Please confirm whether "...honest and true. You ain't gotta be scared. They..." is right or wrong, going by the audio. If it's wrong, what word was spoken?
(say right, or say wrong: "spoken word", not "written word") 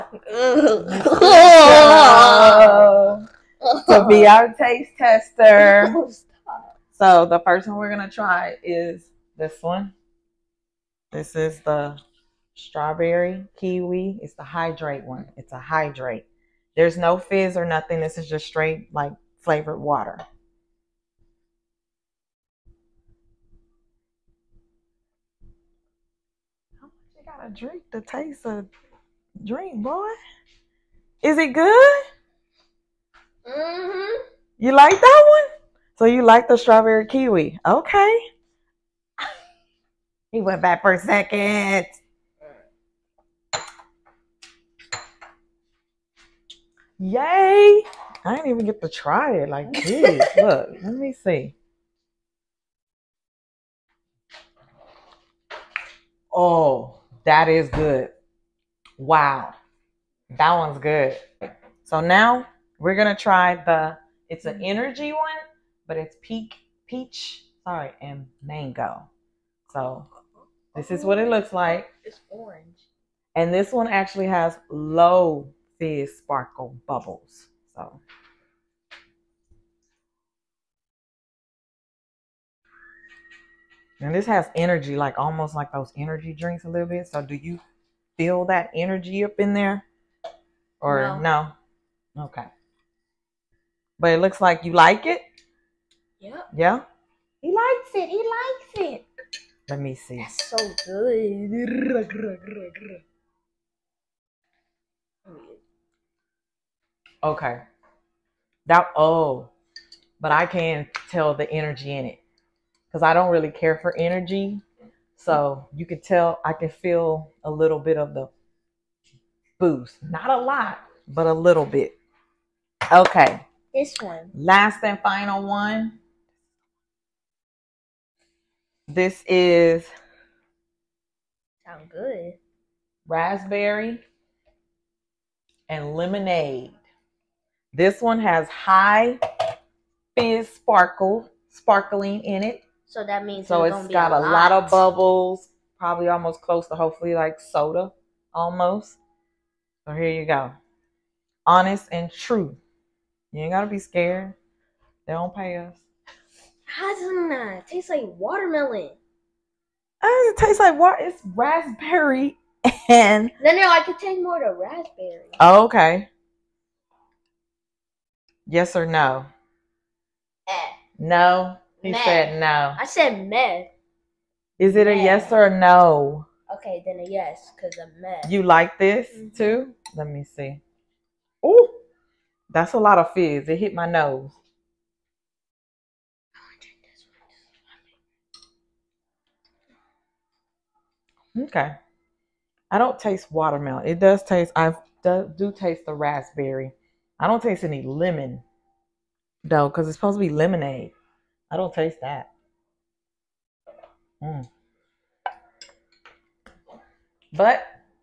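right.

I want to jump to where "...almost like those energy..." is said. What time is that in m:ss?
1:25.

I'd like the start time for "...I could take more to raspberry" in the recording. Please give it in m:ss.
2:43.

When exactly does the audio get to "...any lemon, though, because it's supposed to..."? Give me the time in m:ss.
3:17.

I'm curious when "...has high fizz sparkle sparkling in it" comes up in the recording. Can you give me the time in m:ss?
2:18.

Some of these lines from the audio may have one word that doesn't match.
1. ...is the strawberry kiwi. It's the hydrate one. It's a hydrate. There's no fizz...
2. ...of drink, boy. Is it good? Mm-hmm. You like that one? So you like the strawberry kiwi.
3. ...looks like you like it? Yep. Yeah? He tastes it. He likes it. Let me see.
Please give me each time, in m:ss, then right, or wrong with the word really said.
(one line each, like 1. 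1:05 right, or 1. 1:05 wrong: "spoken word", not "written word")
1. 0:11 right
2. 0:28 right
3. 1:34 wrong: "likes", not "tastes".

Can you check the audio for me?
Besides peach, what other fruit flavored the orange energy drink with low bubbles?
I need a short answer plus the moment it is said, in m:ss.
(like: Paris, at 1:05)
Mango, at 1:08.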